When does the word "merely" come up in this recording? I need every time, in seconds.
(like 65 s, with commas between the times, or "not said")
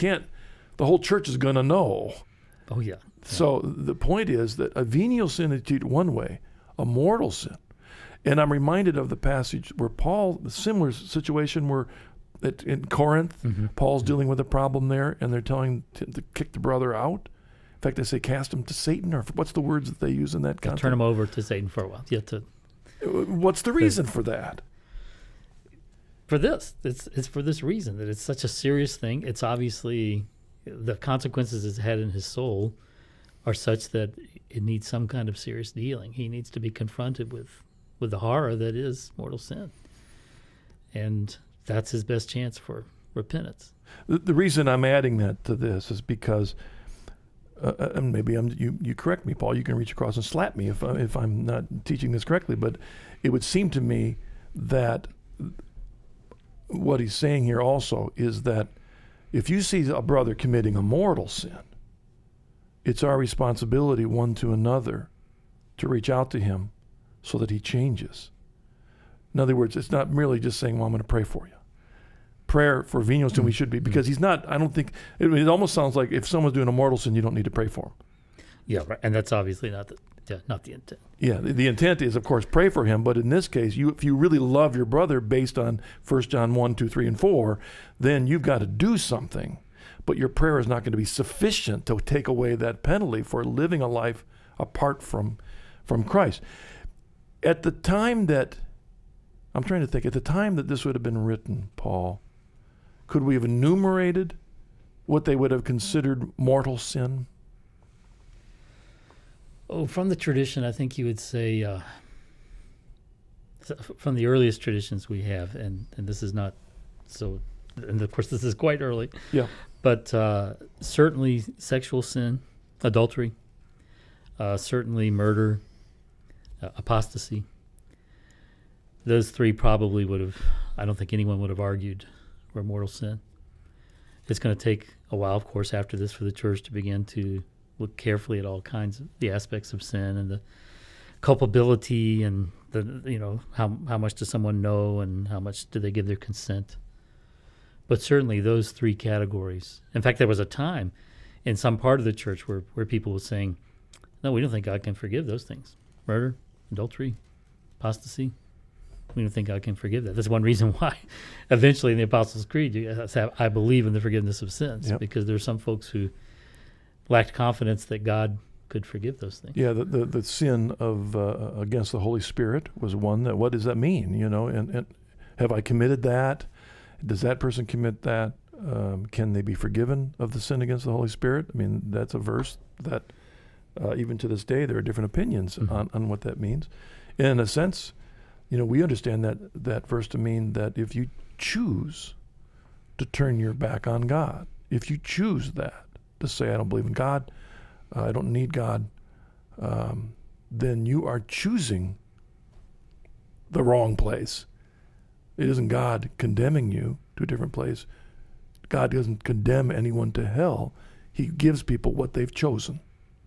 70 s.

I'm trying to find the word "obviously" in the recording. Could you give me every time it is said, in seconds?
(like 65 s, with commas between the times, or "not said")
29 s, 79 s.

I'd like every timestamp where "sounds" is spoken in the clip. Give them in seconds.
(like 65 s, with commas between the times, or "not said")
75 s.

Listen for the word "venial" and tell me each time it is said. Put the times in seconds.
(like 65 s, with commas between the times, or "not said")
4 s, 73 s.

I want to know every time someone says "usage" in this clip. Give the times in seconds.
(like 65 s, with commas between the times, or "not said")
not said.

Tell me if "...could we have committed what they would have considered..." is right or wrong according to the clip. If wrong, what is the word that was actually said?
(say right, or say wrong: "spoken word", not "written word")
wrong: "enumerated", not "committed".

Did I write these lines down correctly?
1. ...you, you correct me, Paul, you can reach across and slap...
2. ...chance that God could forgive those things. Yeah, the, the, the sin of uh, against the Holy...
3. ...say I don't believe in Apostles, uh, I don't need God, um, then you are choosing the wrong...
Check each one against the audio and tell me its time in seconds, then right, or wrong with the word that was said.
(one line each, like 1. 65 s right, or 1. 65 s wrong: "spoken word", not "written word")
1. 48 s right
2. 167 s wrong: "confidence", not "chance"
3. 196 s wrong: "God", not "Apostles".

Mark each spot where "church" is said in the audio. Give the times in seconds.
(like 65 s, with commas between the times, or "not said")
0 s, 136 s, 152 s.